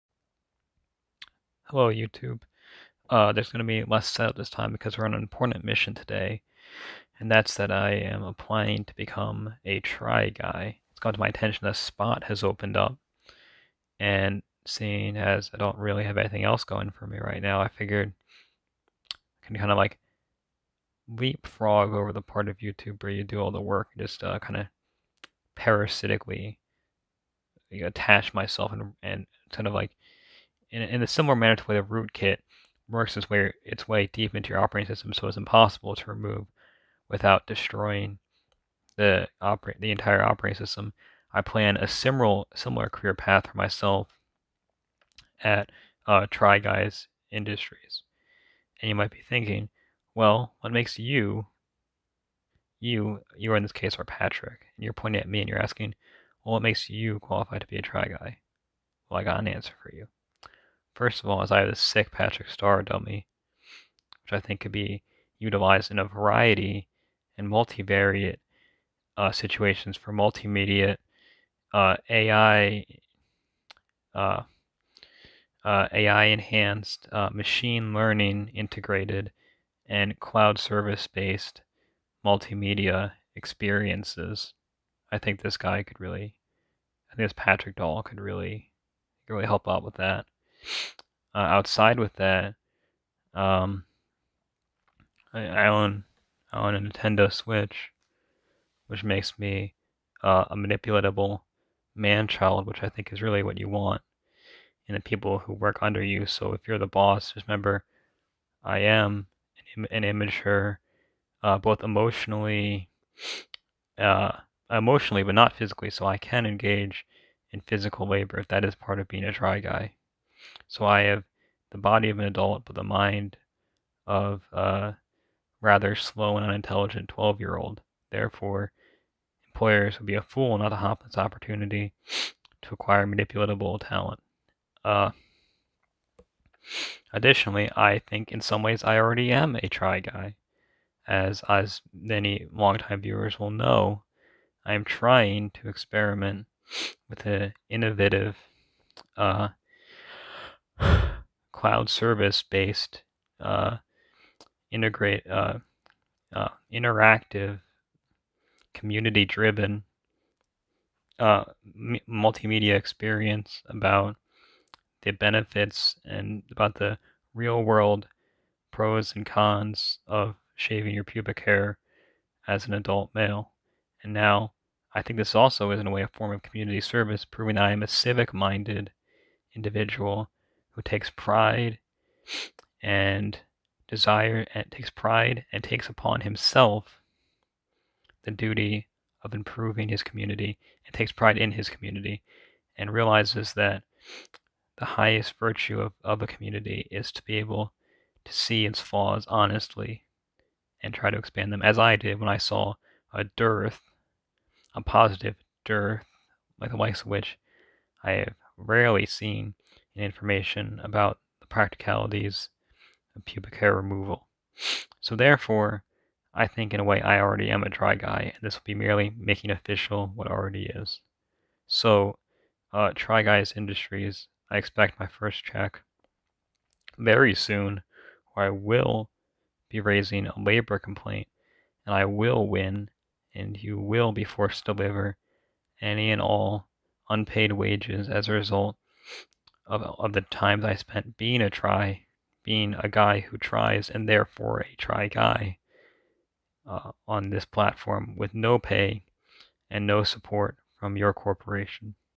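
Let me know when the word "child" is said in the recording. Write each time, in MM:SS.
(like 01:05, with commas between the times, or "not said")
01:42.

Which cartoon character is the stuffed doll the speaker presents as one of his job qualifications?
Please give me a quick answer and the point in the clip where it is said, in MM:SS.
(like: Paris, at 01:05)
Patrick Star, at 01:02.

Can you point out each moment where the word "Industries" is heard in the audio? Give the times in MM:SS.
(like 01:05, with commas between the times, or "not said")
00:47, 03:43.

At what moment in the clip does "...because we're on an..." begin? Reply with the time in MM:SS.
00:04.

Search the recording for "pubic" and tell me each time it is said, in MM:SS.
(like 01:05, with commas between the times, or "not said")
02:51, 03:33.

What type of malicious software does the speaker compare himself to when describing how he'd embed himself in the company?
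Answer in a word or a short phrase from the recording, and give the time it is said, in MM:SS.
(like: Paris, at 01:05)
rootkit, at 00:31.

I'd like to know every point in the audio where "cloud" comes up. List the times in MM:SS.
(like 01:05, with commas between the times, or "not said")
01:20, 02:31.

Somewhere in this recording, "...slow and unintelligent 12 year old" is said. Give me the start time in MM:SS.
02:05.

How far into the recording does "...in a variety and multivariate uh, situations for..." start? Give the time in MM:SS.
01:05.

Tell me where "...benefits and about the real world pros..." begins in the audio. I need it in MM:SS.
02:45.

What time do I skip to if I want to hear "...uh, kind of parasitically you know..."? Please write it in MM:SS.
00:24.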